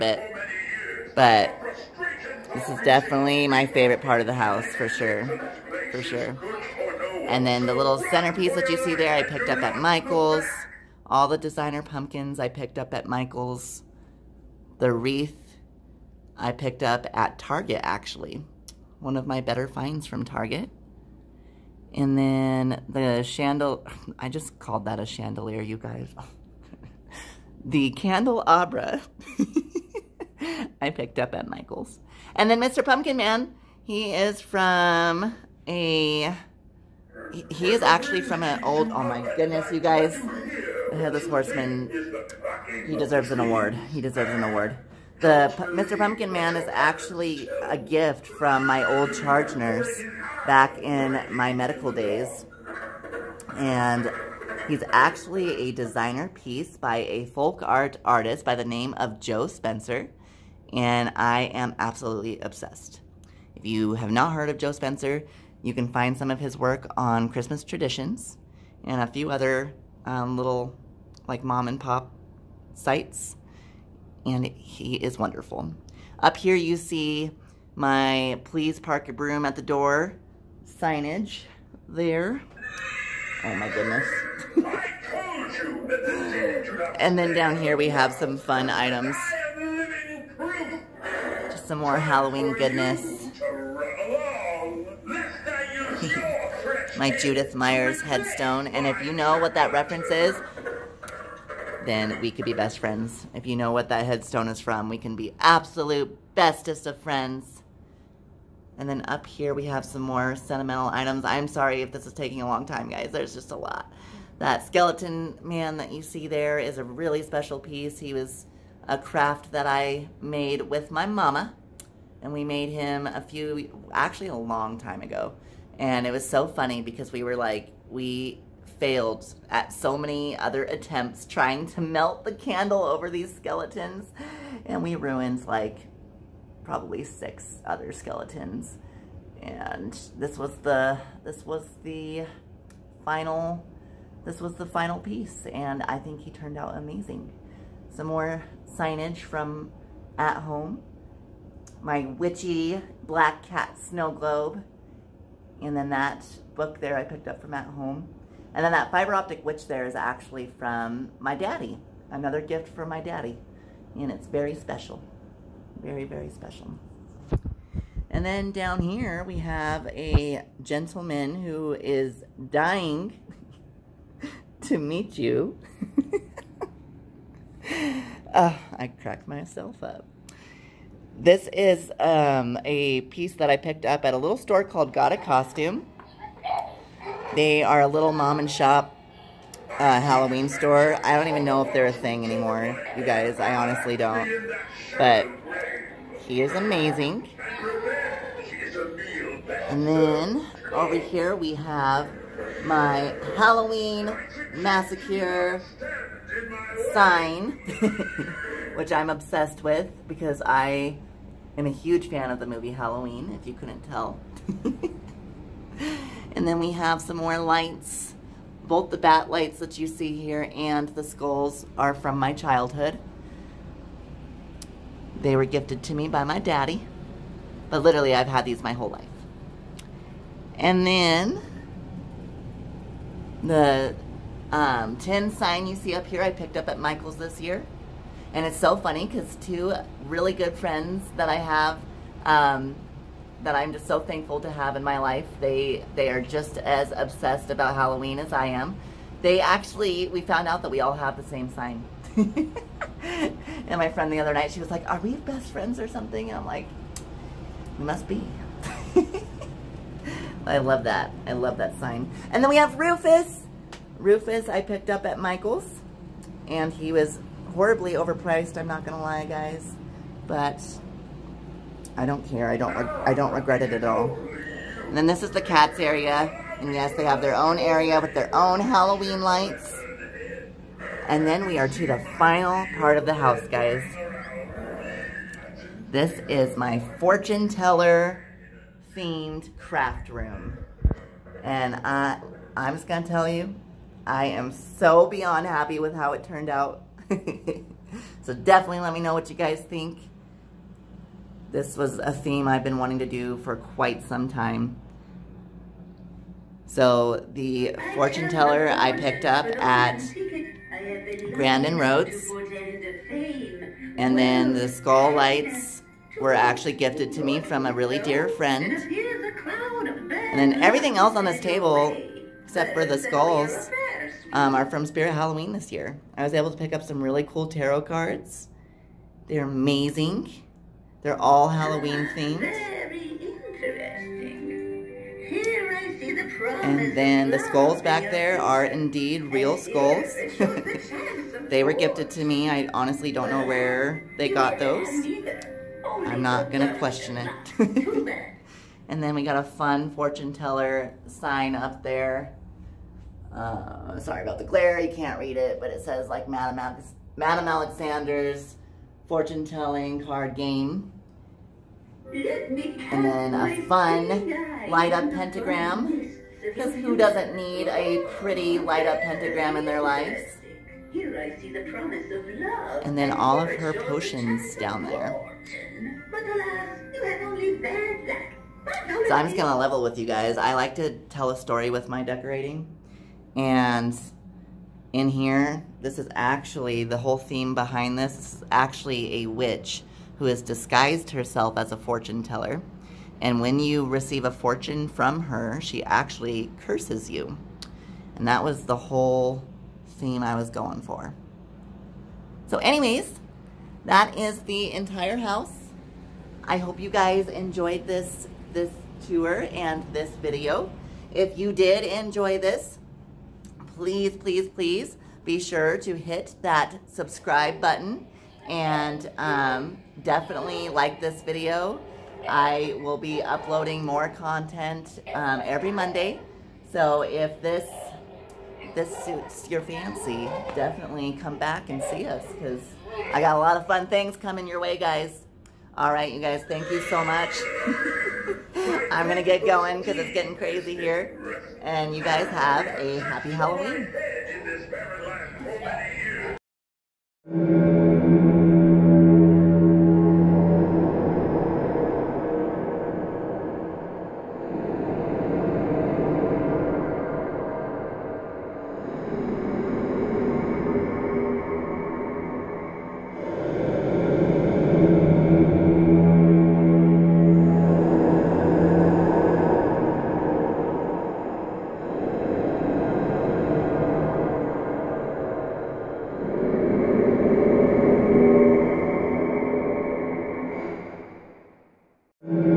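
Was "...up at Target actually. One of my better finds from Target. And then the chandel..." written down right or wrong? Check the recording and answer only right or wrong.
right.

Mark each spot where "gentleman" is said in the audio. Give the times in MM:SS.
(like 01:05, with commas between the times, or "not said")
02:50.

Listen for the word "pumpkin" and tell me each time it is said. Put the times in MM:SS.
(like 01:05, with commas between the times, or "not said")
00:11, 00:32, 00:45.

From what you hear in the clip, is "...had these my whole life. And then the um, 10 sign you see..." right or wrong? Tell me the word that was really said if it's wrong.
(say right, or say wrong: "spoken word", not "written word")
right.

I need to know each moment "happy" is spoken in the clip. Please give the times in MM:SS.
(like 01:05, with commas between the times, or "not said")
04:55, 07:22.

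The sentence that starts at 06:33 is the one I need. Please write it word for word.
And when you receive a fortune from her, she actually curses you.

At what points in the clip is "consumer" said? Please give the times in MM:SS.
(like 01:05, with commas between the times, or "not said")
not said.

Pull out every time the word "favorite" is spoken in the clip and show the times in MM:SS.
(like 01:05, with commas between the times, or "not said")
00:03.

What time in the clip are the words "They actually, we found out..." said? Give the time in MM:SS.
04:09.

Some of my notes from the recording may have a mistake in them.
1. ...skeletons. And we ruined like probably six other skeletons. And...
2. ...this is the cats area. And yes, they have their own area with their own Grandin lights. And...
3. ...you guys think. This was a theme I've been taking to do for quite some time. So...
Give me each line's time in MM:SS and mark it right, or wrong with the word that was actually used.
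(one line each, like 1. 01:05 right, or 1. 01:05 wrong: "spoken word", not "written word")
1. 02:13 right
2. 04:35 wrong: "Halloween", not "Grandin"
3. 04:59 wrong: "wanting", not "taking".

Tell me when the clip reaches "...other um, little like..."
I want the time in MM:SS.
01:09.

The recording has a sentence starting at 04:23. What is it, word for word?
Rufus I picked up at Michael's.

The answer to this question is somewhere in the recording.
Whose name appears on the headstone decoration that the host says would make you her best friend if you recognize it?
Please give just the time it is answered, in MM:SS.
01:37.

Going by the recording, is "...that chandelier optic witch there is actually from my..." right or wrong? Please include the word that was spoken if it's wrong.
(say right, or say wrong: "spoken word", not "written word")
wrong: "fiber", not "chandelier".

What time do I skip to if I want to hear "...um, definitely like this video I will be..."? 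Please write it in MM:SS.
06:59.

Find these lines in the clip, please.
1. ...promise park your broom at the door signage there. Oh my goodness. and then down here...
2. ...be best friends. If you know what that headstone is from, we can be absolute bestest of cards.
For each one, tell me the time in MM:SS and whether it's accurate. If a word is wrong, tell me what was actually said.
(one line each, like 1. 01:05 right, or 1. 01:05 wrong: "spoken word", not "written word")
1. 01:18 wrong: "please", not "promise"
2. 01:42 wrong: "friends", not "cards".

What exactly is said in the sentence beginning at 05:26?
I was able to pick up some really cool tarot cards.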